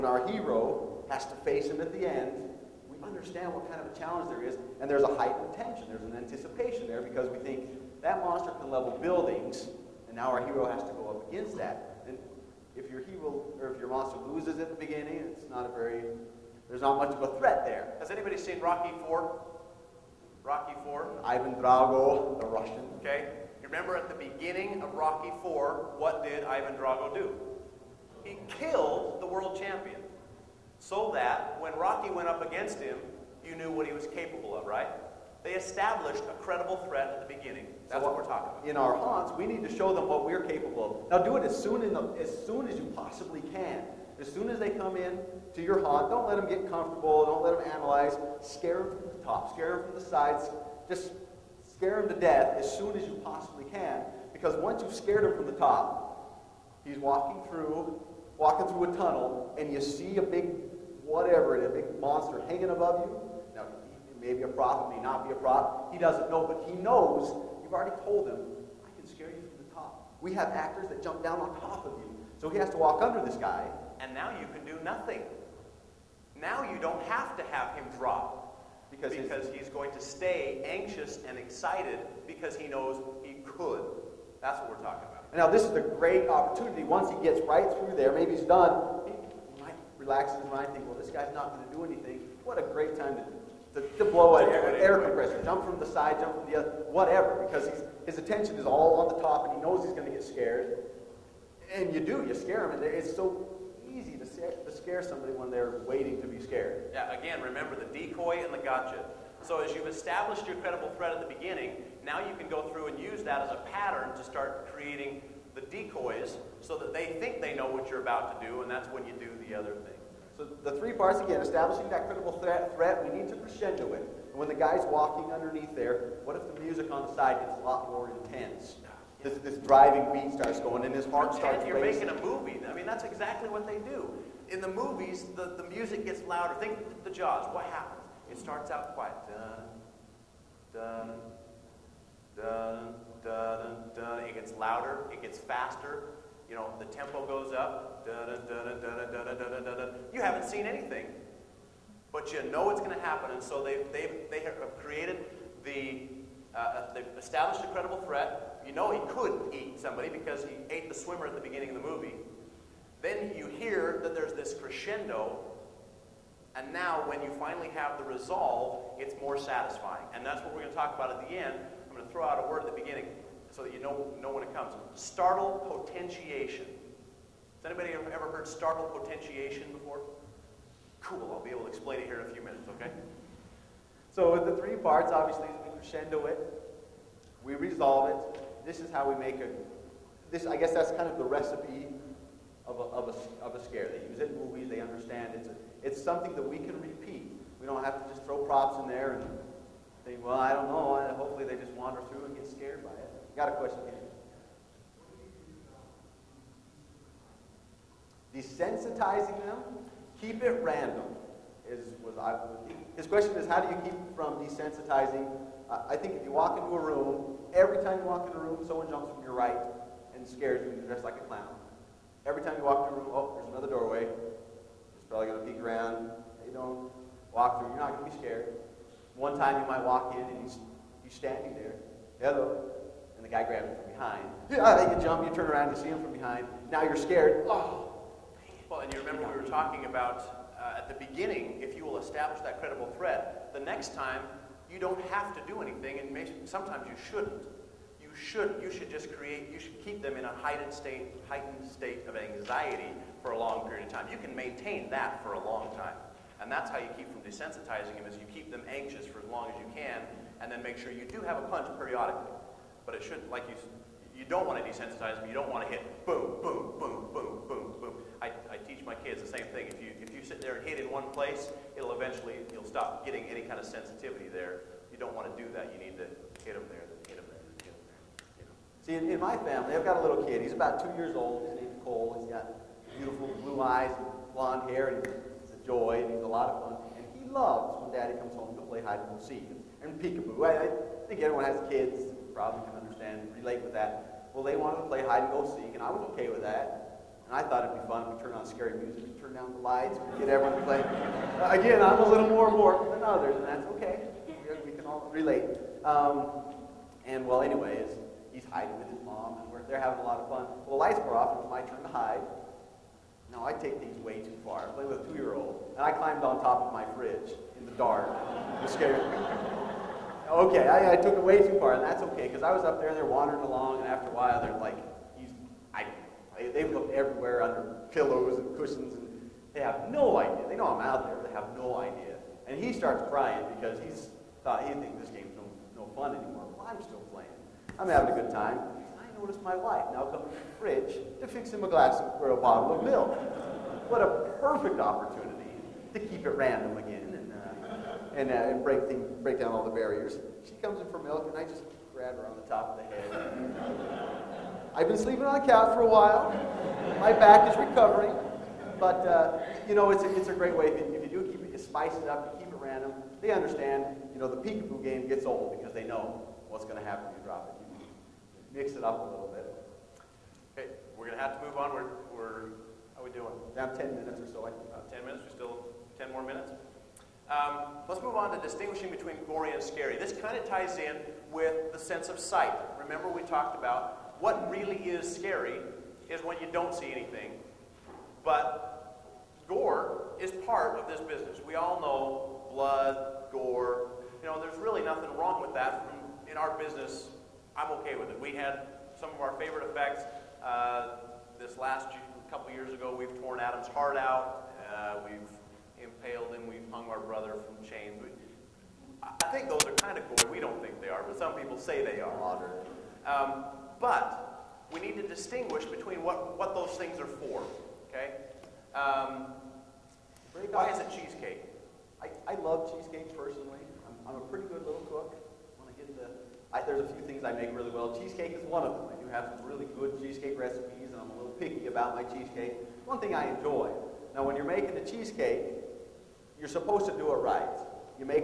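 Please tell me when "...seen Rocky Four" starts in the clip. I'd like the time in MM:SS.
00:18.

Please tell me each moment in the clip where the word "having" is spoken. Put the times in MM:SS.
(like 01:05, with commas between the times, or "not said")
05:09, 05:37.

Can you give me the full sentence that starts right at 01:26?
Once he gets right through there, maybe he's done relaxes his mind, Think well, this guy's not going to do anything.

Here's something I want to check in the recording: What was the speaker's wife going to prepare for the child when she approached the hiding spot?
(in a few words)
A bottle of milk.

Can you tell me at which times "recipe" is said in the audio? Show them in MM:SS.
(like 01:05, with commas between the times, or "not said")
03:11, 07:10.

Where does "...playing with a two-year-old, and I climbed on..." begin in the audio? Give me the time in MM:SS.
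05:14.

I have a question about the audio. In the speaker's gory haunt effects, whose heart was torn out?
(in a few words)
Adam's.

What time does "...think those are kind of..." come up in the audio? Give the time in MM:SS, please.
06:49.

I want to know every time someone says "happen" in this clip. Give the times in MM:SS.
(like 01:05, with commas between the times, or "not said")
02:17, 02:33, 06:06.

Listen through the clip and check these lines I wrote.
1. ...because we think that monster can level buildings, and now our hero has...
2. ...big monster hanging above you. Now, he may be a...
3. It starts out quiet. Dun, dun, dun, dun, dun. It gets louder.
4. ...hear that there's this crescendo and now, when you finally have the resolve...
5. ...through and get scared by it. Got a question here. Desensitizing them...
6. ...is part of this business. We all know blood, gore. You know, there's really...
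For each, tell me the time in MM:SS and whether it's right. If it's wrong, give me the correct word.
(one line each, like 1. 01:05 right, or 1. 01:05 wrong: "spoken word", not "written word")
1. 00:07 right
2. 01:01 right
3. 02:18 right
4. 02:43 right
5. 03:22 right
6. 06:30 right.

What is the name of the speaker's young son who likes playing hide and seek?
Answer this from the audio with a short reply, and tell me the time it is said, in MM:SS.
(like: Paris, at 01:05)
Cole, at 04:41.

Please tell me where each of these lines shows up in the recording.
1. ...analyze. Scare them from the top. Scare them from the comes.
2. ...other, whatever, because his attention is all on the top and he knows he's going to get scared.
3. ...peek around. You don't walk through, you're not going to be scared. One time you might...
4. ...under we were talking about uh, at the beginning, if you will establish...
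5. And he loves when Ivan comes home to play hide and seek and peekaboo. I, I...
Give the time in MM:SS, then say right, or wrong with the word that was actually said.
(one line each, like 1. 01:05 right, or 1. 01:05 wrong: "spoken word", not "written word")
1. 00:47 wrong: "sides", not "comes"
2. 01:36 right
3. 03:45 right
4. 03:58 wrong: "remember", not "under"
5. 04:46 wrong: "Daddy", not "Ivan".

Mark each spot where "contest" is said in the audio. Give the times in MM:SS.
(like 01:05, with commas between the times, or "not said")
not said.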